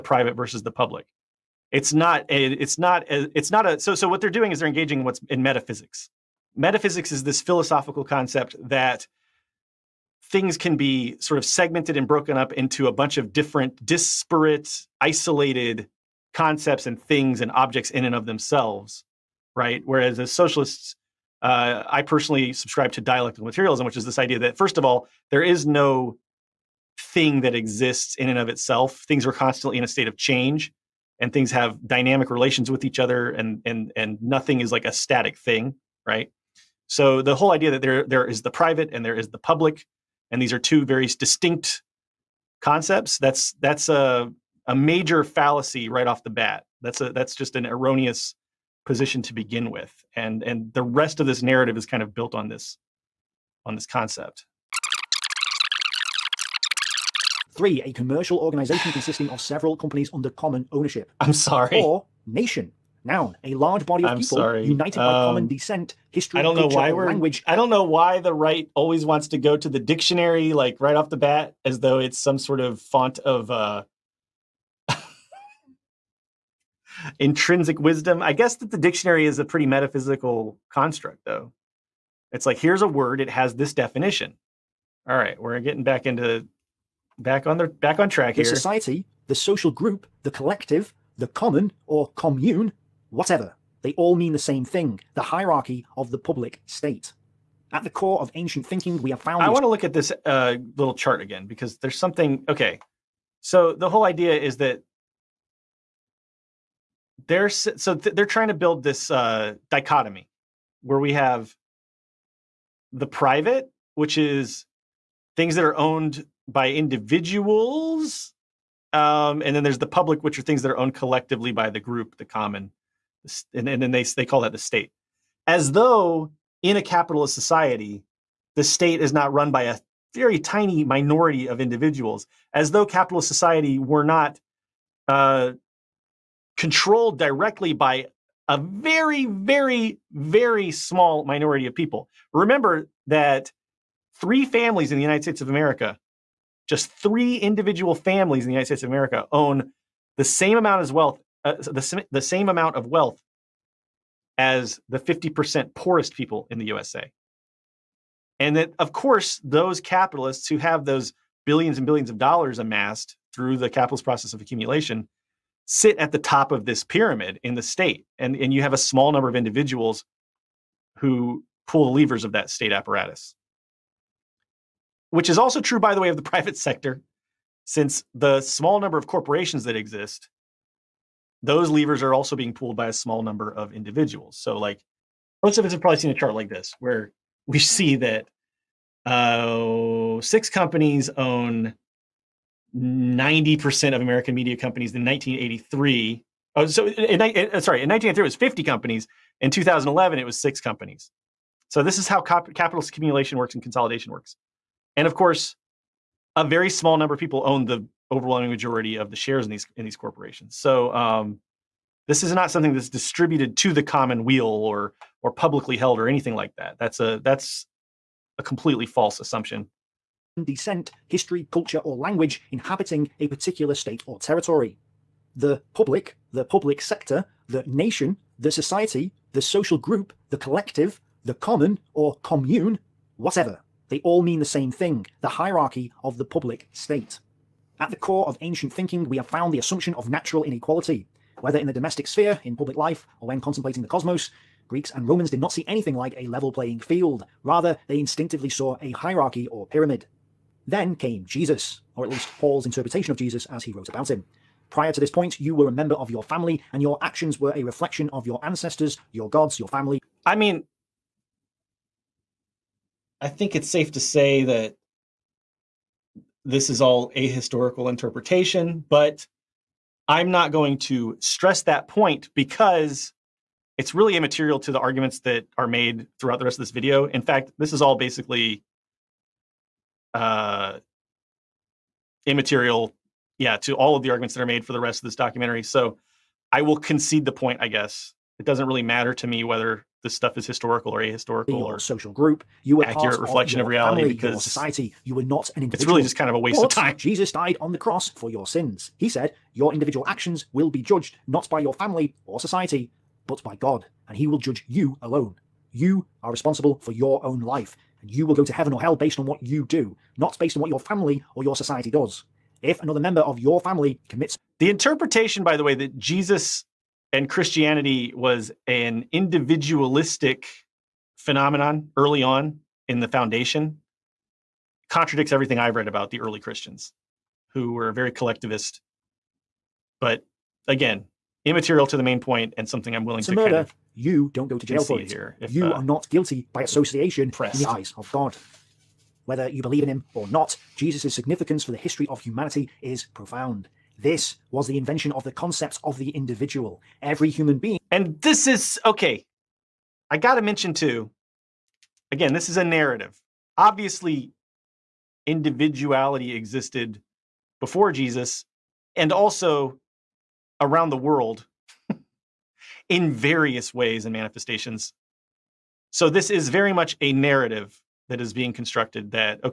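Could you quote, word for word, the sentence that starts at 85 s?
All right, we're getting back into back on the back on track the here.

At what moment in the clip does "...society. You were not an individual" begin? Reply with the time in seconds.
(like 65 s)
294 s.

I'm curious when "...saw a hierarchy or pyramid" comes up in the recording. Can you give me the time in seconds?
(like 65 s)
248 s.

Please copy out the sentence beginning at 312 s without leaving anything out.
If another member of your family commits.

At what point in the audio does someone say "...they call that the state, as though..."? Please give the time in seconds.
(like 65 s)
124 s.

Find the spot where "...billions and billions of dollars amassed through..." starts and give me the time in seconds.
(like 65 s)
161 s.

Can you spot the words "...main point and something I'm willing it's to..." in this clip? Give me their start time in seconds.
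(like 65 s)
332 s.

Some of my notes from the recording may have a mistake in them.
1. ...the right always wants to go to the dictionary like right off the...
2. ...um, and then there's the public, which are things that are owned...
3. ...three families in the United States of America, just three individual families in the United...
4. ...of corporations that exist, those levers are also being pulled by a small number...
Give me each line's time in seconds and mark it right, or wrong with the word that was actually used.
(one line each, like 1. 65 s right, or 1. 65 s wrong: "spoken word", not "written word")
1. 68 s right
2. 118 s right
3. 144 s right
4. 178 s right.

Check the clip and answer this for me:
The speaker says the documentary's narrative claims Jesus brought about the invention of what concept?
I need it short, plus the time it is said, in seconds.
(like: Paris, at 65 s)
The individual, at 345 s.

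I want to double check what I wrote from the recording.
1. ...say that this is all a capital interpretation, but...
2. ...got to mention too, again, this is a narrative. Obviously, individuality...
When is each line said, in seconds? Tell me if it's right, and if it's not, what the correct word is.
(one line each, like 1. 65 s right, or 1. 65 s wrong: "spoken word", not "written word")
1. 264 s wrong: "historical", not "capital"
2. 350 s right.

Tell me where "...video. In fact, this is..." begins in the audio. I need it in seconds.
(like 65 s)
276 s.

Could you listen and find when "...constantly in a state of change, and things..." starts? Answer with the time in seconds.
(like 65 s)
29 s.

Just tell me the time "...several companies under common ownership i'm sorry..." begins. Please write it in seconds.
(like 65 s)
59 s.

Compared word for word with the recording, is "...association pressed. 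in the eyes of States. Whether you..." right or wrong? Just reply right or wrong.
wrong.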